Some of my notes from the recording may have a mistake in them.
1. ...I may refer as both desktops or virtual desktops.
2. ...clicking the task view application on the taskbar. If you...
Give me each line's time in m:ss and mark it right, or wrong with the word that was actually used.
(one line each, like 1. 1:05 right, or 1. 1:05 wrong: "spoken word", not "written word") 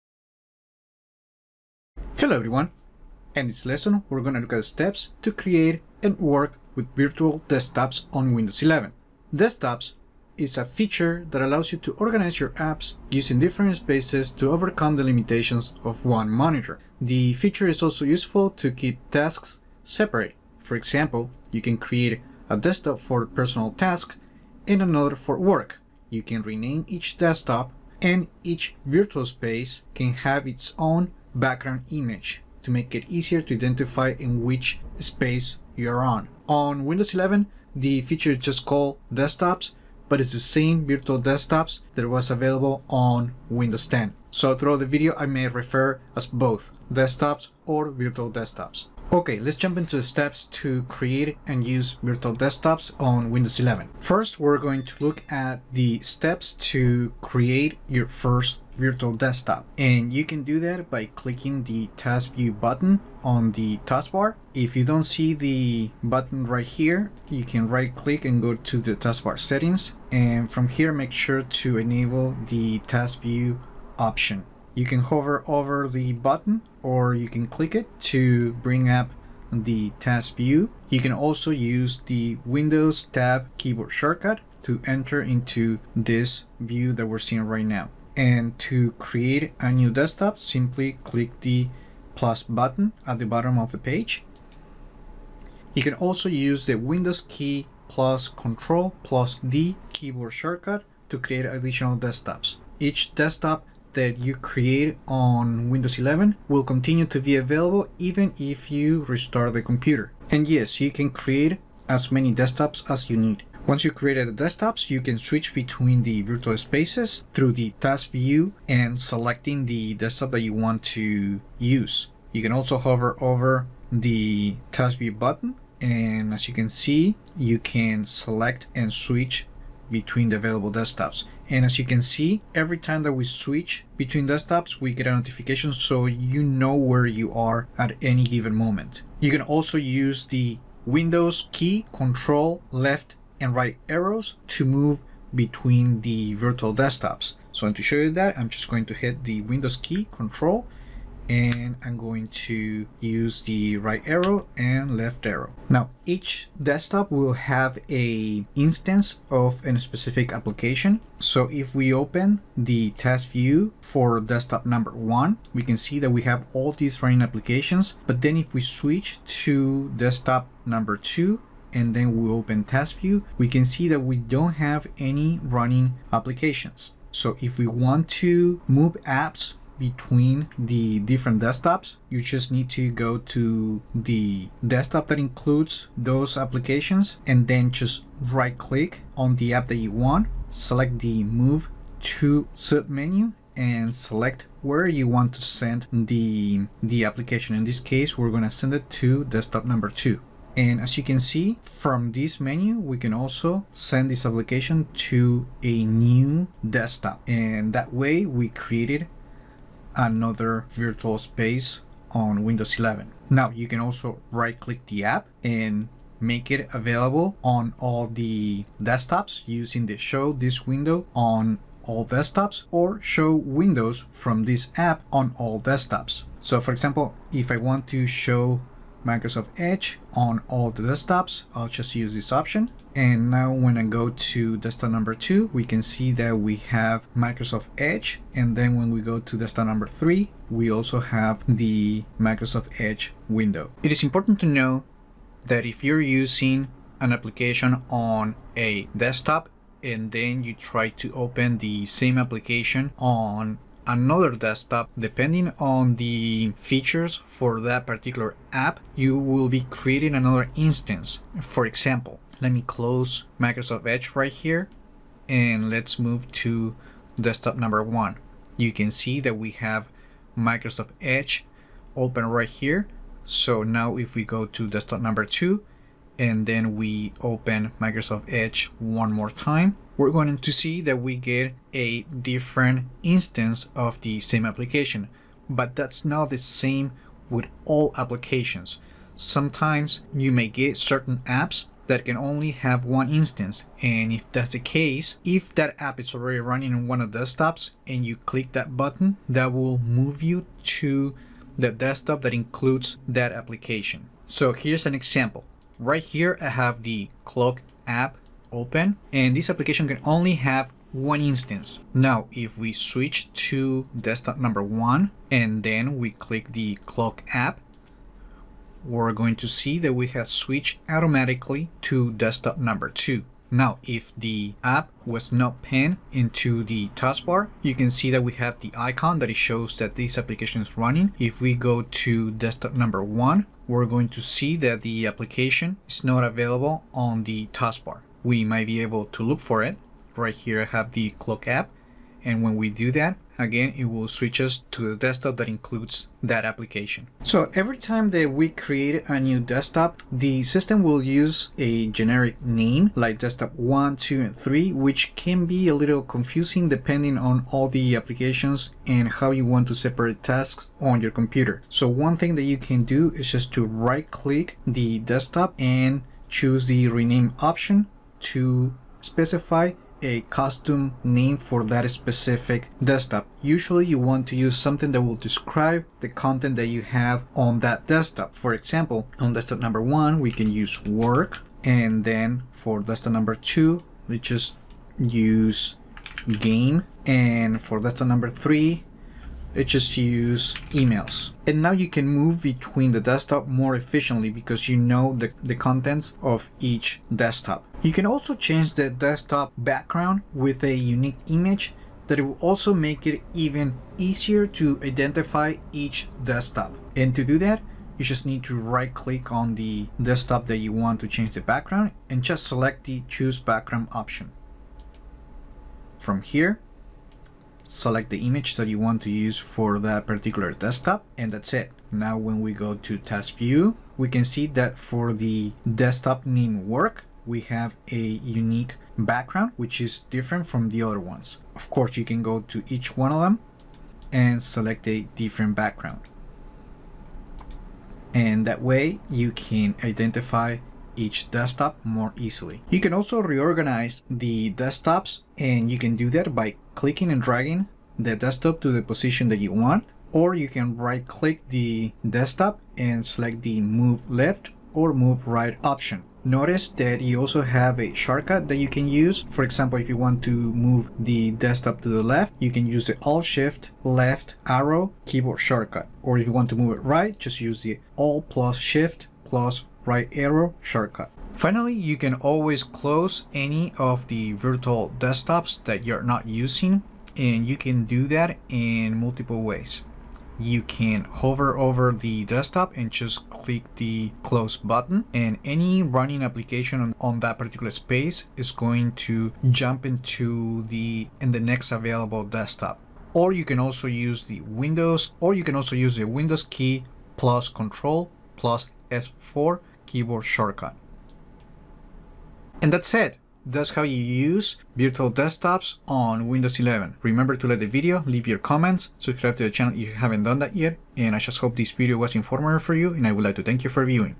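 1. 0:45 right
2. 1:01 wrong: "button", not "application".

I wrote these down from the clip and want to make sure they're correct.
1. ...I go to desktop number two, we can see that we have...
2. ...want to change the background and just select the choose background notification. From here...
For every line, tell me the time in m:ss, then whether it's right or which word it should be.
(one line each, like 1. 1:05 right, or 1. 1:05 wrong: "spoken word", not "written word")
1. 3:53 right
2. 6:50 wrong: "option", not "notification".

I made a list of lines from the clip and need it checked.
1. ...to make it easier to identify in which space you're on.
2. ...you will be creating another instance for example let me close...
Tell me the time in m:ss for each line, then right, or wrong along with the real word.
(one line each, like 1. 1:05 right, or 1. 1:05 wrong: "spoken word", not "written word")
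1. 0:32 right
2. 4:18 right.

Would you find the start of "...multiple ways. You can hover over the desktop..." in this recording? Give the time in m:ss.
7:58.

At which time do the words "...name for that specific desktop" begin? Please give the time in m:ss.
6:11.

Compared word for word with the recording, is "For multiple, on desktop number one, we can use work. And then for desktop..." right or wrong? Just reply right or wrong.
wrong.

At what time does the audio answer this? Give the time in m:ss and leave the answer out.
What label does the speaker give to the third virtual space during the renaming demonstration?
6:30.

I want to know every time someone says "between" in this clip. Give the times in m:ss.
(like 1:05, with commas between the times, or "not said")
1:55, 2:09, 2:13, 2:25, 2:59, 6:32.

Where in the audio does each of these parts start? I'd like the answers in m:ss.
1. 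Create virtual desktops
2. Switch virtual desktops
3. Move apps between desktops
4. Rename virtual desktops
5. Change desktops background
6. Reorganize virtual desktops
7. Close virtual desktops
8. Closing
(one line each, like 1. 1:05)
1. 0:49
2. 1:53
3. 2:36
4. 5:47
5. 6:37
6. 7:23
7. 7:51
8. 8:22.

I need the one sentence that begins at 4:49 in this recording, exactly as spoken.
Sometimes you may get certain apps that can only have one instance.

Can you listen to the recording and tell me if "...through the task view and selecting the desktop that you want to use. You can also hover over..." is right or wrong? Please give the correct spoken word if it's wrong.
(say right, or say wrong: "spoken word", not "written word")
right.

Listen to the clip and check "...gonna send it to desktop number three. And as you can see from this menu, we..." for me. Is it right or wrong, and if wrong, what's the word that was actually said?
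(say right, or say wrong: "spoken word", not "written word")
wrong: "two", not "three".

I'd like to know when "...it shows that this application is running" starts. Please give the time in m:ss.
5:29.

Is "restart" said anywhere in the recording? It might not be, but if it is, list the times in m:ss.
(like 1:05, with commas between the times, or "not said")
1:49.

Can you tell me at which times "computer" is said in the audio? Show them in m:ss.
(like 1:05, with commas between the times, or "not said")
1:49, 6:01.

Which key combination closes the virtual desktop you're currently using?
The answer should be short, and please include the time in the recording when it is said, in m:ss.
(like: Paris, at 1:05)
Windows key + Control + F4, at 8:16.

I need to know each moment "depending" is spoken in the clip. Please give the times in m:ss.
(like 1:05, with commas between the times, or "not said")
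4:14, 5:56.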